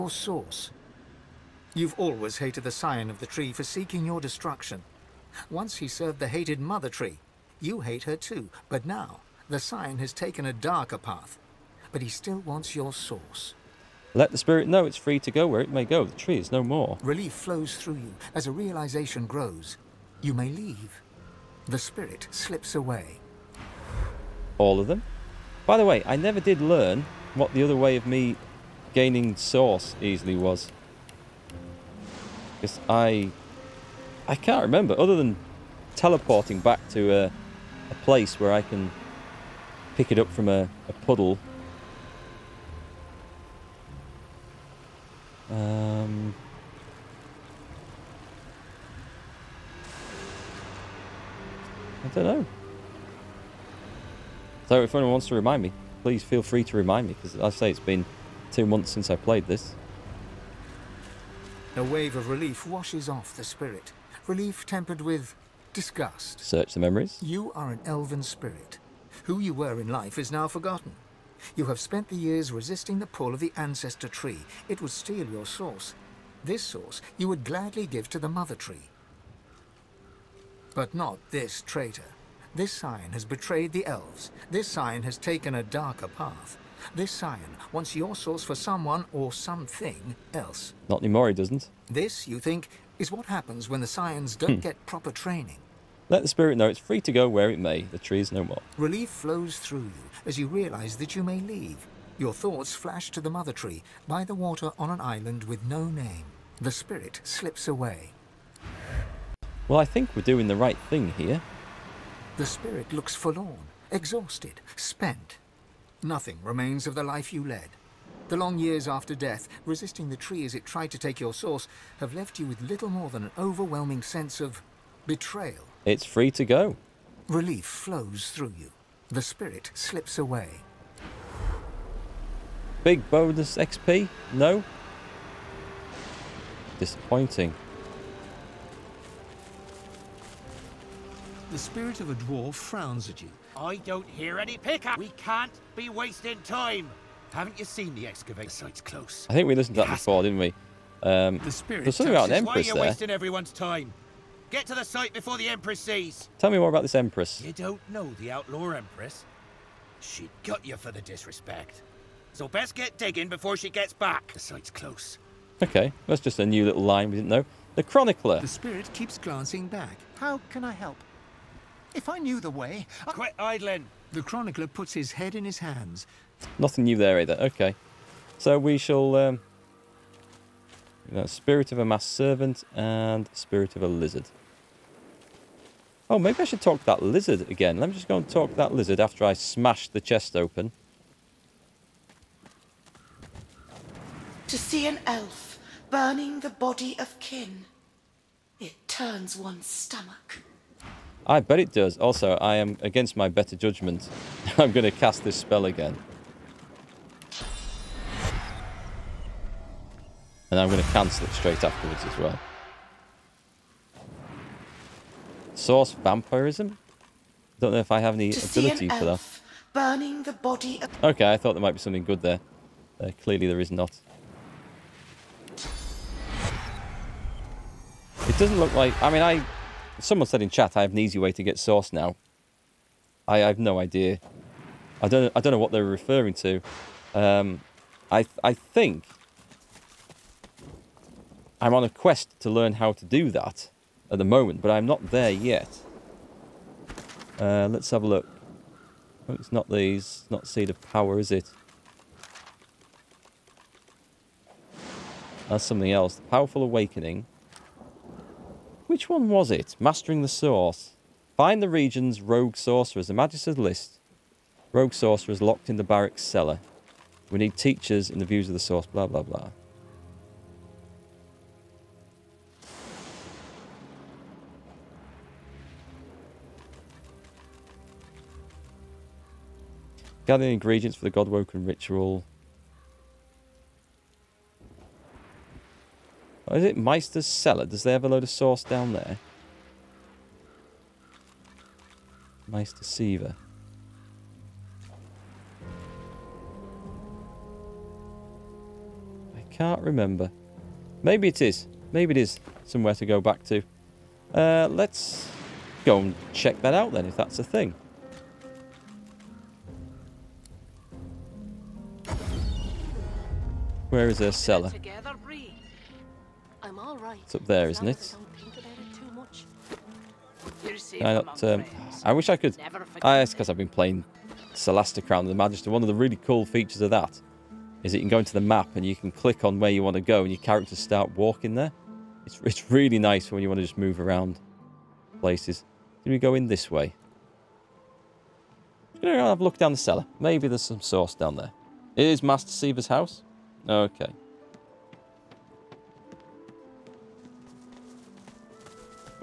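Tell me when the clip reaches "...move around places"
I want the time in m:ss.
5:33.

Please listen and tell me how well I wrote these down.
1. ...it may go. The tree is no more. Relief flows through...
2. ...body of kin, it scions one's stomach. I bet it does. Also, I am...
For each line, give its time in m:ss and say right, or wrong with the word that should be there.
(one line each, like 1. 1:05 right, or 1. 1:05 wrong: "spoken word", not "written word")
1. 0:15 right
2. 3:16 wrong: "turns", not "scions".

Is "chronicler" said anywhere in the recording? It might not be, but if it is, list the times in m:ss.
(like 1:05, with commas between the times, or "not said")
2:47, 2:54.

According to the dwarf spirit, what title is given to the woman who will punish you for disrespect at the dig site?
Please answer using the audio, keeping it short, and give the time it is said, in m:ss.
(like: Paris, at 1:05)
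outlaw empress, at 2:38.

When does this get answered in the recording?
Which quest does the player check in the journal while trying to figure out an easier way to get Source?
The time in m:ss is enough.
4:19.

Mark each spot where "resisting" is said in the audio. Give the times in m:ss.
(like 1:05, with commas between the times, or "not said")
1:12, 1:59.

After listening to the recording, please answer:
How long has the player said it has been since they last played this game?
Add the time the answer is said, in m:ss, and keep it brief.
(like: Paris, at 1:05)
2 months, at 0:58.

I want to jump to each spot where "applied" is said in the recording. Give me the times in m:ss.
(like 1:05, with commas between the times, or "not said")
not said.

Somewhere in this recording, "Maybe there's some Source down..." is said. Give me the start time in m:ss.
5:40.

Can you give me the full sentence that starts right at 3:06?
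Oh, maybe I should talk to that lizard again.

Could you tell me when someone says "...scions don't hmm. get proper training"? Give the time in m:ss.
1:33.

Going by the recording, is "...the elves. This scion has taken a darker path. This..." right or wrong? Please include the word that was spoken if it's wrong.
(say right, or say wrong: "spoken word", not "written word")
right.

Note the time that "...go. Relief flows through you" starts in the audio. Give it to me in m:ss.
2:06.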